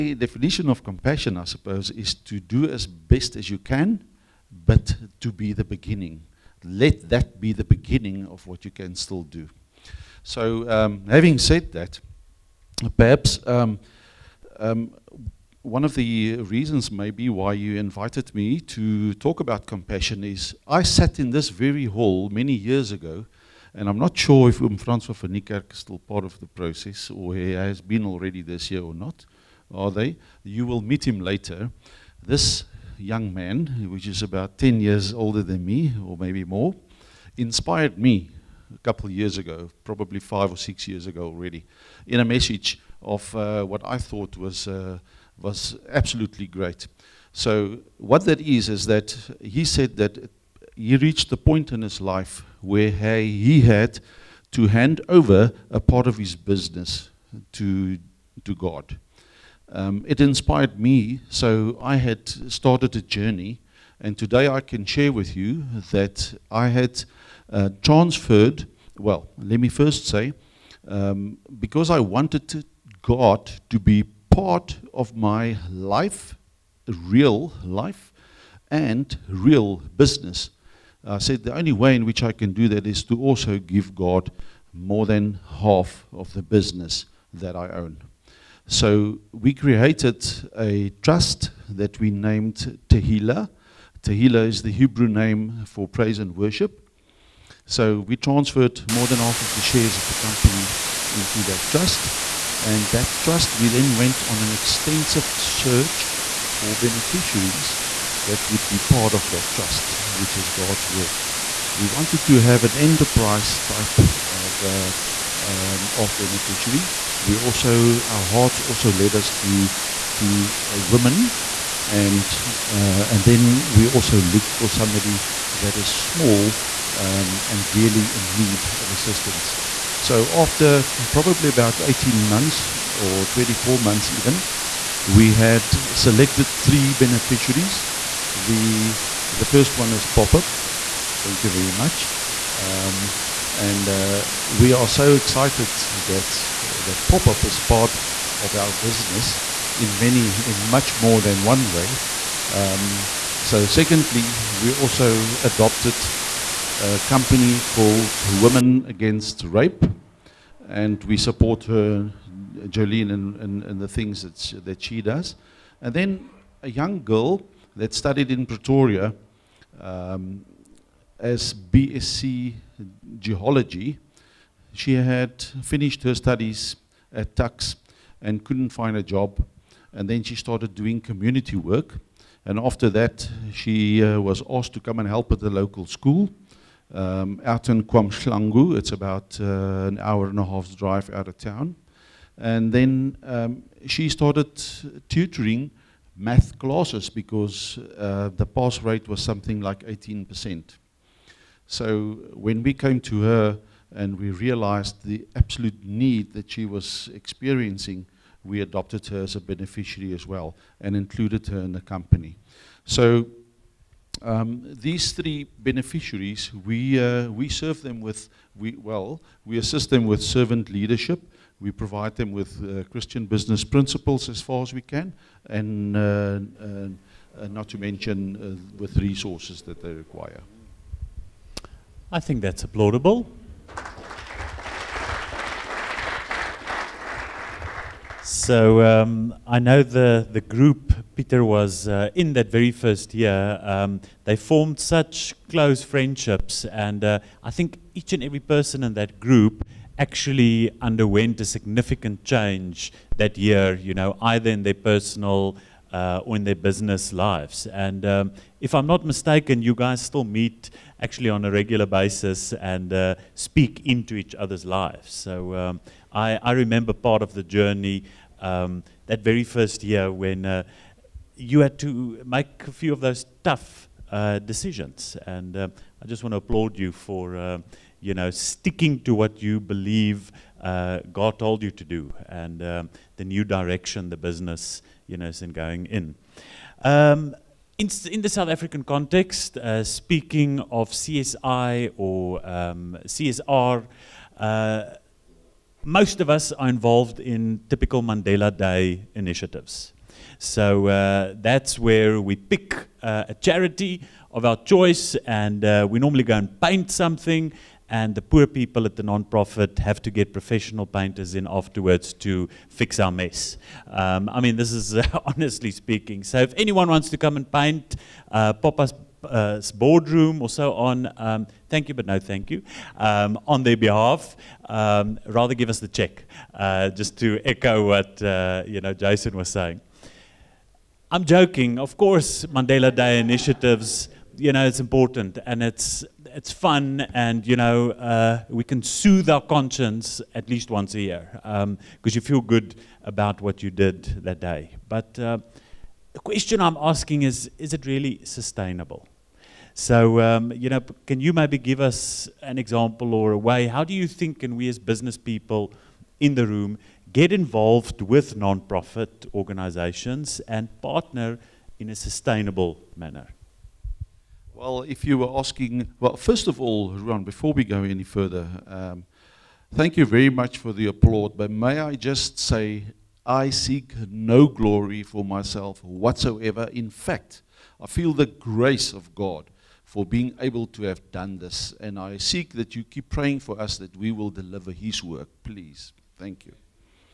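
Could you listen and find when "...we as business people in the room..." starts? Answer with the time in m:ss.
5:54.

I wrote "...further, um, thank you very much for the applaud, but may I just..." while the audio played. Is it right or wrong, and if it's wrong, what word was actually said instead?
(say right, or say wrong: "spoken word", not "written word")
right.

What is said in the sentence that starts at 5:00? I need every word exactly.
So uh, that's where we pick uh, a charity of our choice, and uh, we normally go and paint something.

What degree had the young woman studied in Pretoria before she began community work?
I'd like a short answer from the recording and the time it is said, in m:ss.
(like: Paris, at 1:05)
BSc Geology, at 2:51.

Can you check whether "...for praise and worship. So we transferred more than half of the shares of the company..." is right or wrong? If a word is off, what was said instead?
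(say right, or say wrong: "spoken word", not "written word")
right.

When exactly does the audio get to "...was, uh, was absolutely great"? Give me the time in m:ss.
0:44.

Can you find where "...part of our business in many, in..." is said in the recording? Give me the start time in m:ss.
2:27.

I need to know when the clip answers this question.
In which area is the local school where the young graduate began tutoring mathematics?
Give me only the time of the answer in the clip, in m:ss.
3:07.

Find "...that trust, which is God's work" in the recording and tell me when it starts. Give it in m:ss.
1:49.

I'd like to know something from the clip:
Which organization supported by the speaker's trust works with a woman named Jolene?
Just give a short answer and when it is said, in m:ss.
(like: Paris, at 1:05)
Women Against Rape, at 2:38.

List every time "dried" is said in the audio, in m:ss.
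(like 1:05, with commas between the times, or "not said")
not said.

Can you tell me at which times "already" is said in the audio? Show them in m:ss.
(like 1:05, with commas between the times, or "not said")
0:28, 0:41.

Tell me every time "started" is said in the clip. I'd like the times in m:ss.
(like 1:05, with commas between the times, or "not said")
1:02, 3:00, 3:14.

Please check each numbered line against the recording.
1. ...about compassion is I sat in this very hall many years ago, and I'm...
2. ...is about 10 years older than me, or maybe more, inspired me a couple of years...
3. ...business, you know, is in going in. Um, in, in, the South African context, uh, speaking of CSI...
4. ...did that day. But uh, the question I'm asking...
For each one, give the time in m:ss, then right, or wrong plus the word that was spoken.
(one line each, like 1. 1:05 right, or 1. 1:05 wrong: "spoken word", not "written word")
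1. 0:19 right
2. 0:34 right
3. 4:44 right
4. 5:43 right.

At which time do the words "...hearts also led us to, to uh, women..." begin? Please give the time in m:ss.
1:58.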